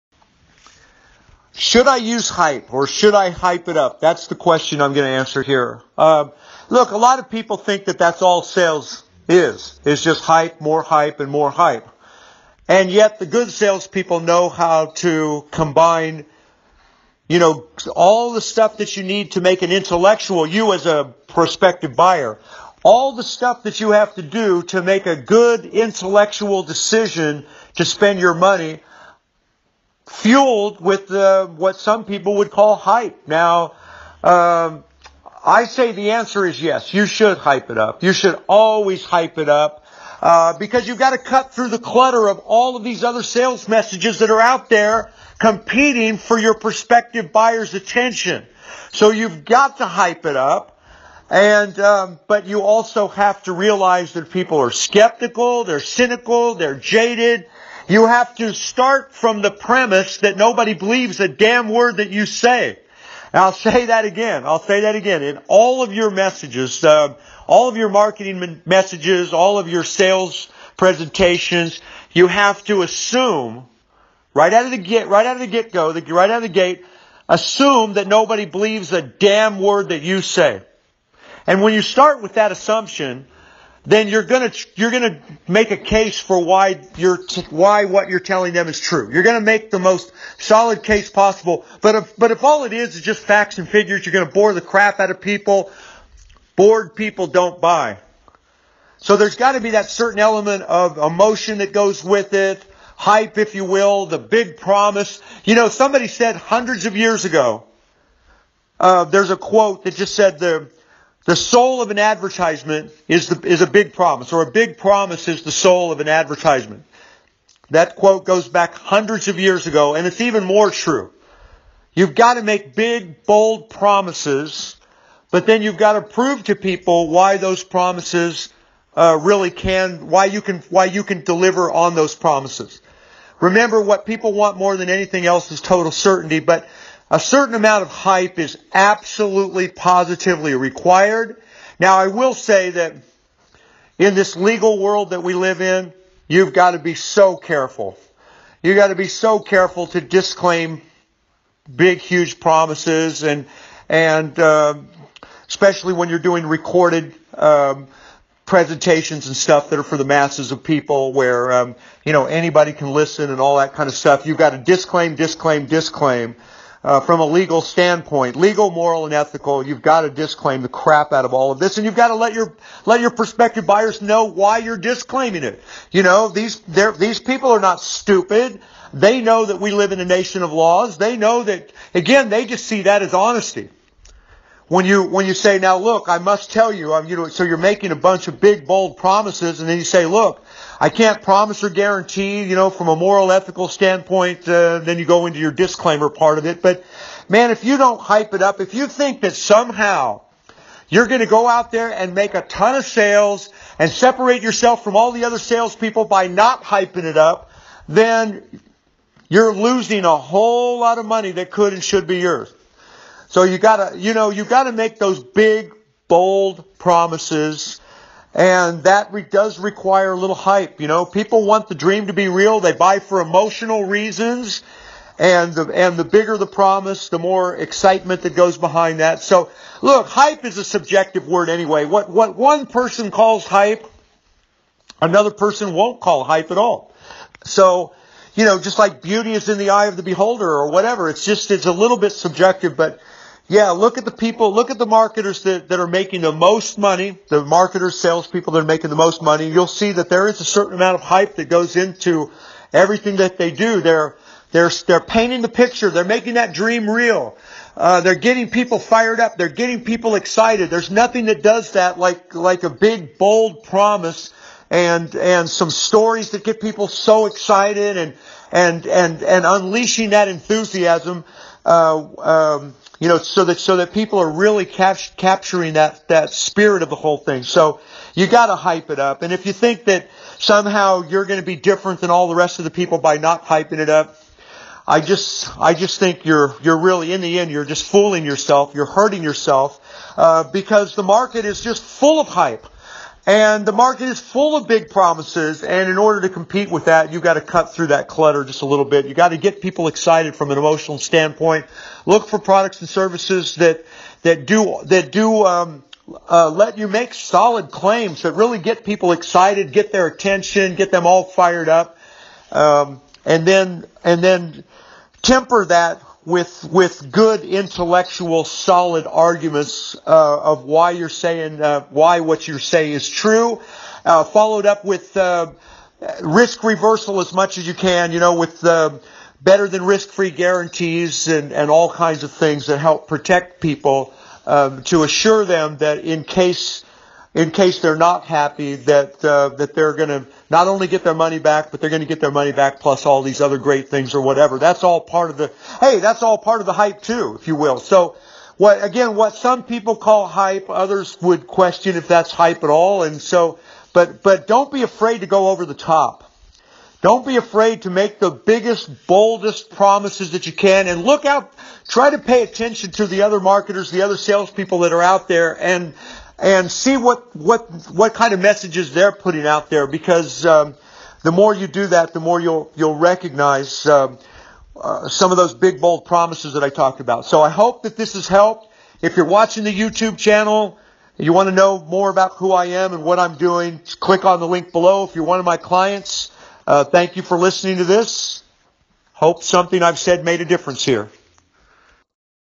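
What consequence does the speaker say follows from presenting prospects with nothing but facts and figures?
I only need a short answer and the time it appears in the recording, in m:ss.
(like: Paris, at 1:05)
Bored people don't buy, at 1:36.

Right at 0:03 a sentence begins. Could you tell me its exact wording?
That's the question I'm going to answer here.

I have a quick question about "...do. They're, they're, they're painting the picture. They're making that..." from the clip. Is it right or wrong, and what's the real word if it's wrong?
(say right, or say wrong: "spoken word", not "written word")
right.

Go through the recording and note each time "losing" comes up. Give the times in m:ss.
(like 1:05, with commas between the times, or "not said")
3:29.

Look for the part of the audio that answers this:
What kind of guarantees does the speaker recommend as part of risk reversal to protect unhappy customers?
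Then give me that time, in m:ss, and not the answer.
5:29.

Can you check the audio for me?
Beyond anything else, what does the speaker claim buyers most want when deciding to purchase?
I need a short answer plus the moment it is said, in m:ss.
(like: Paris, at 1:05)
Total certainty, at 2:15.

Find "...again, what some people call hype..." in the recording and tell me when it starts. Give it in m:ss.
5:48.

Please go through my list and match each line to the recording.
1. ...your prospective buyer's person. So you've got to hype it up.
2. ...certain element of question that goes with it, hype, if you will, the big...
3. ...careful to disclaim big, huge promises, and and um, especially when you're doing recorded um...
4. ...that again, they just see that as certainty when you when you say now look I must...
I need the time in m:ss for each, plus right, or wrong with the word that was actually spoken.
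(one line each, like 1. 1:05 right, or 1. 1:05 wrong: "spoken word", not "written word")
1. 0:46 wrong: "attention", not "person"
2. 1:39 wrong: "emotion", not "question"
3. 2:29 right
4. 3:01 wrong: "honesty", not "certainty".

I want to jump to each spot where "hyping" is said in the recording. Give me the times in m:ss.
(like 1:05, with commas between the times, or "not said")
3:26, 4:43.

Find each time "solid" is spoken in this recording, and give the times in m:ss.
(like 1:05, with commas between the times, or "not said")
1:30, 5:07, 5:18.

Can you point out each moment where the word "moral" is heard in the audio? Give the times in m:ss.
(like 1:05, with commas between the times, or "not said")
2:48, 3:12.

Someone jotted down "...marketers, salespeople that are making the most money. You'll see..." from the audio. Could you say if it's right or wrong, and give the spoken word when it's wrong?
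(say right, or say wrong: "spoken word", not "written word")
right.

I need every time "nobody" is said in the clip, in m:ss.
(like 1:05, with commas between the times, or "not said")
1:00, 1:18.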